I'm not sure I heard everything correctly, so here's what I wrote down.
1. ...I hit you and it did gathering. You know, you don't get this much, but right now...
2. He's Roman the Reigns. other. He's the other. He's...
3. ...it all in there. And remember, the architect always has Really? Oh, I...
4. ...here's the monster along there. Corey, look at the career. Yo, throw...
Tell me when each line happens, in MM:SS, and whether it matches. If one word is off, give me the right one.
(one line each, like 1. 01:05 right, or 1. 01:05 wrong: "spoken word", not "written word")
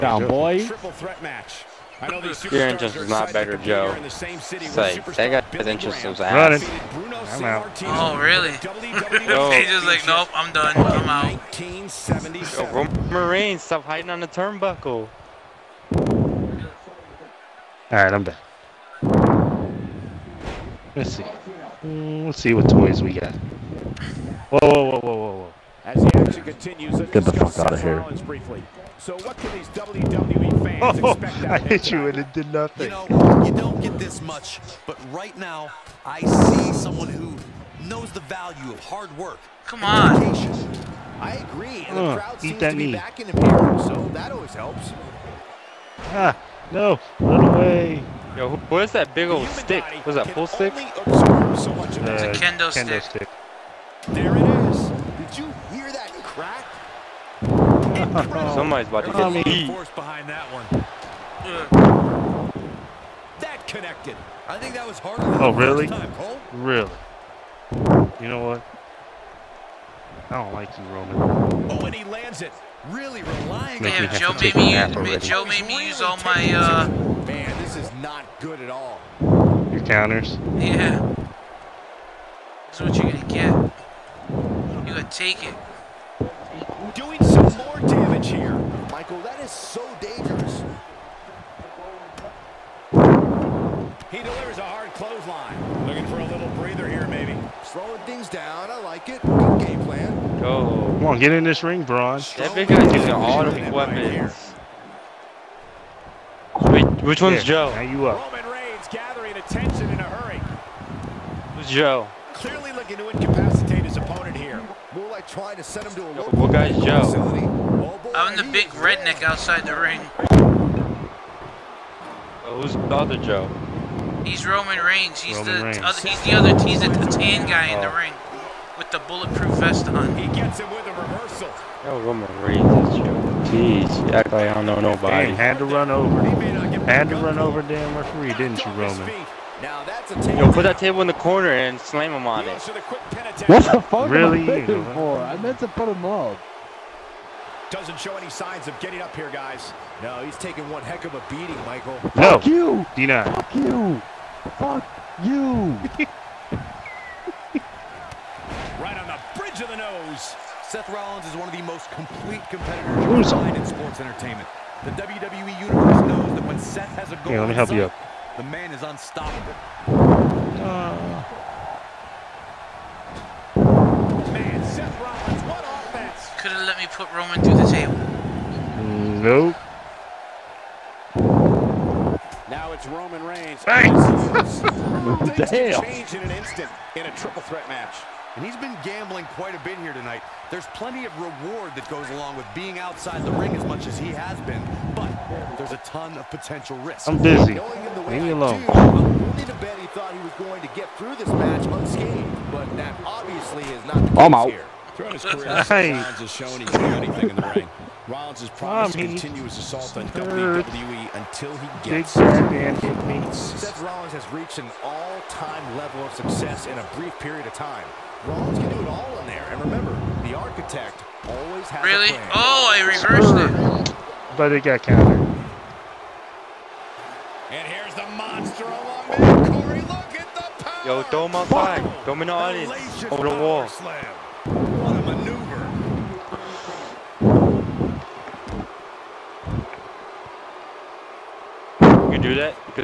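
1. 00:31 wrong: "nothing", not "gathering"
2. 02:05 right
3. 03:38 right
4. 03:47 wrong: "power", not "career".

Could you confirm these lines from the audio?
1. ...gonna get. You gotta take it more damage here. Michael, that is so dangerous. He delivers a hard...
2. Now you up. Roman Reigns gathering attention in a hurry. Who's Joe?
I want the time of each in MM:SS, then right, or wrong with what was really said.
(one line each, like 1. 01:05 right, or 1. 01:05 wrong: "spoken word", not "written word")
1. 01:23 right
2. 01:47 right.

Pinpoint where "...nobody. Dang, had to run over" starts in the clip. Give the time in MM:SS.
02:14.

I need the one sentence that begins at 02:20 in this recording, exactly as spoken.
Yo, put that table in the corner and slam him on it.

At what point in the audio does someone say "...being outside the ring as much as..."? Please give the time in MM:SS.
03:12.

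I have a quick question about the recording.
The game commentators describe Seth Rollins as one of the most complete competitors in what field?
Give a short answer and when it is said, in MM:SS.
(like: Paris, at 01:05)
sports entertainment, at 02:43.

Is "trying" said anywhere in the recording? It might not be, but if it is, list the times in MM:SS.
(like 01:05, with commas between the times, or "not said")
01:55.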